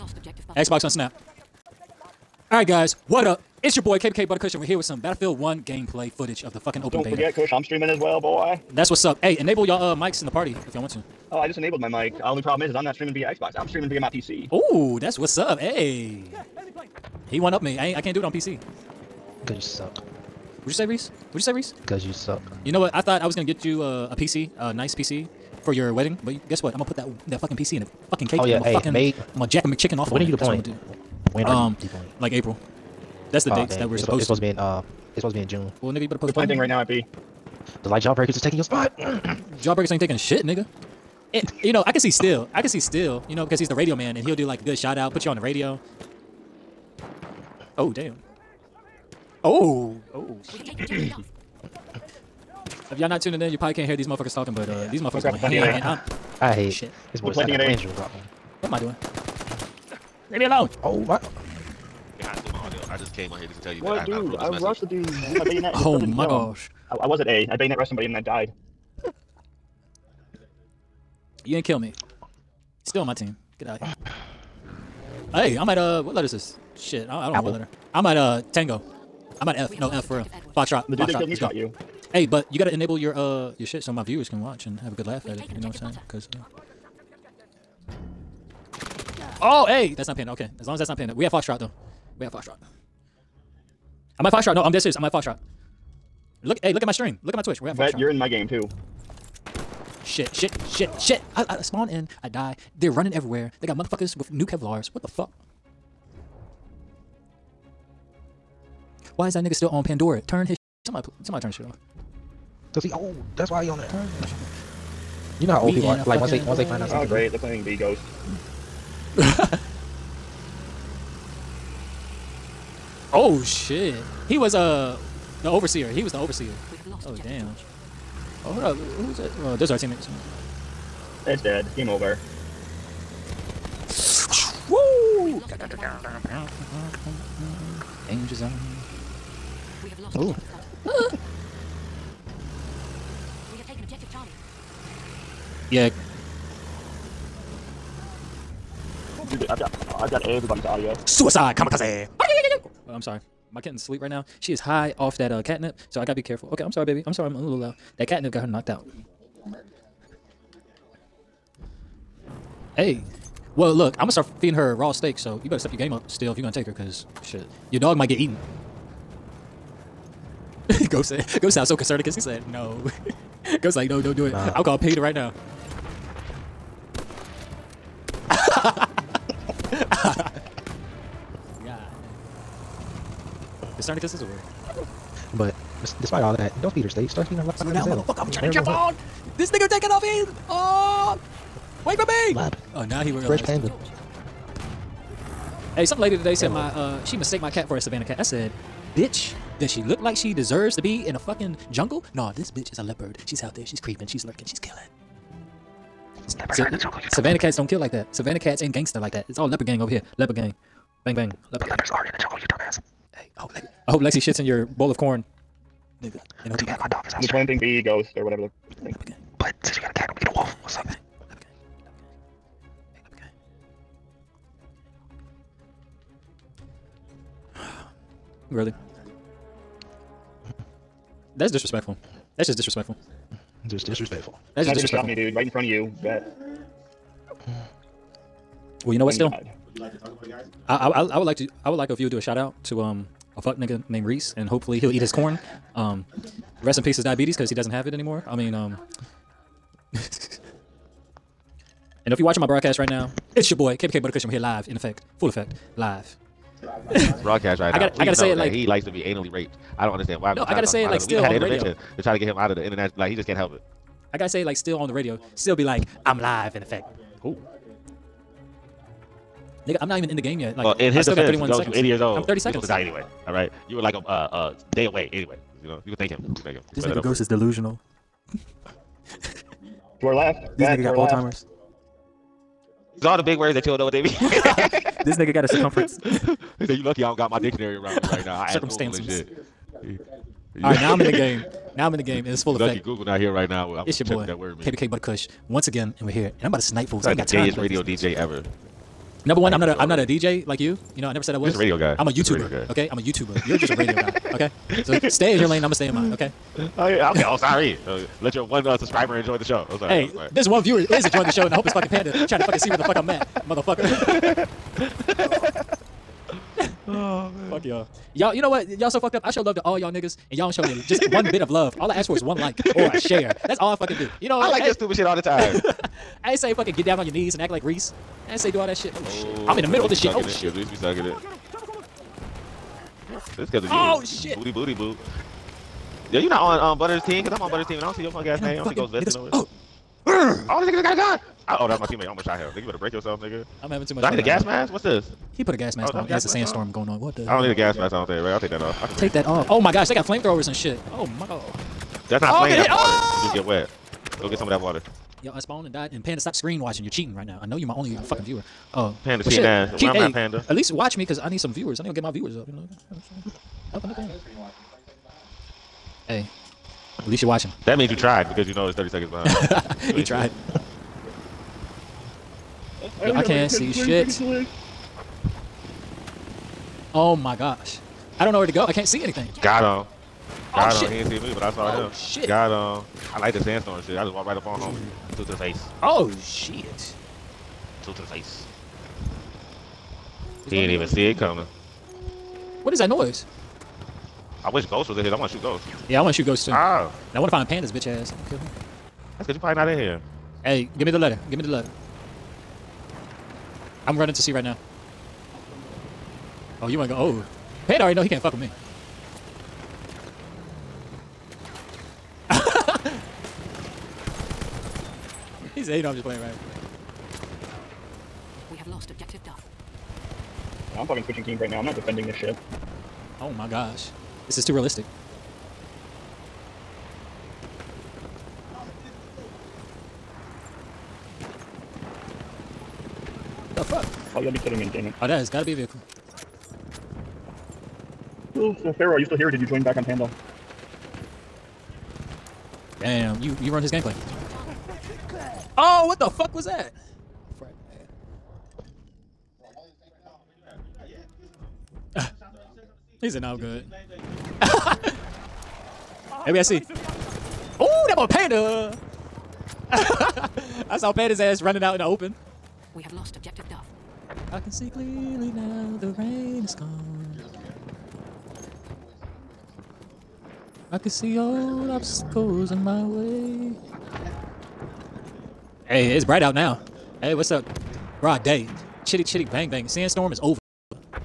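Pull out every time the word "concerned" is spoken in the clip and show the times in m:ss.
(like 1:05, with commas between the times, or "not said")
2:51, 3:03.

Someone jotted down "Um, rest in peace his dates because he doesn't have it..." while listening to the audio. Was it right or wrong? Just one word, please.
wrong.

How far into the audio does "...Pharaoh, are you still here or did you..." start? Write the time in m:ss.
7:18.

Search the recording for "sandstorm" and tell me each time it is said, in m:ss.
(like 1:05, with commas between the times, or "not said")
5:46, 6:23, 7:59.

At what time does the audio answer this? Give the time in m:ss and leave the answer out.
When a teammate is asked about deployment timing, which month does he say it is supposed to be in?
0:35.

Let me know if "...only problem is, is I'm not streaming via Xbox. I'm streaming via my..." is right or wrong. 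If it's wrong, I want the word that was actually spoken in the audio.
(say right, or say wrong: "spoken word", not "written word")
right.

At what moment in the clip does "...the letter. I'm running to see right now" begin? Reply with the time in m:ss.
6:41.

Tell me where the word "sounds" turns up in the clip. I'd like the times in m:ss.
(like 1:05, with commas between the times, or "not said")
2:51.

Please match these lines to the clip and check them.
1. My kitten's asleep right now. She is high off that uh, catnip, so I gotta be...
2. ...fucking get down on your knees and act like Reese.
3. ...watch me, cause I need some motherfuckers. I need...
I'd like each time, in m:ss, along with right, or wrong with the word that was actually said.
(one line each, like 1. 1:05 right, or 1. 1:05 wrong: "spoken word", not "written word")
1. 2:33 right
2. 5:26 right
3. 6:00 wrong: "viewers", not "motherfuckers".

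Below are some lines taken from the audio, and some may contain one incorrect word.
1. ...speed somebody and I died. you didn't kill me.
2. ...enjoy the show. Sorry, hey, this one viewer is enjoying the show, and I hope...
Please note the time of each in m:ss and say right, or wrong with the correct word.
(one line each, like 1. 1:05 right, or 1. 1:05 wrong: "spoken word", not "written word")
1. 1:07 wrong: "rushed", not "speed"
2. 5:09 right.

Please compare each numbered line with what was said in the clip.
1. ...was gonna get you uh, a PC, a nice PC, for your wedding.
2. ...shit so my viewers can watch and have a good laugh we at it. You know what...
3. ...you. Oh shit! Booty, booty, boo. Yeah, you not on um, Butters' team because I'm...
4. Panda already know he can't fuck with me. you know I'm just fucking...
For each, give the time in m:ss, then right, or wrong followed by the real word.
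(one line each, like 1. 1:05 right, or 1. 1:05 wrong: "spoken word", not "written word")
1. 0:23 right
2. 1:23 right
3. 5:33 right
4. 6:47 wrong: "playing", not "fucking".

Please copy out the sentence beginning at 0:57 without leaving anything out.
This boy's planting an What am I doing?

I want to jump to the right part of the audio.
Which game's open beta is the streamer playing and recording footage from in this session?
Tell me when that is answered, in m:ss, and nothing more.
0:05.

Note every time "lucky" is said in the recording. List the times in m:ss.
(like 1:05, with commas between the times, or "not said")
4:46, 4:52.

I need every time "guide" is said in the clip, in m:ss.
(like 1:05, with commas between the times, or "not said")
not said.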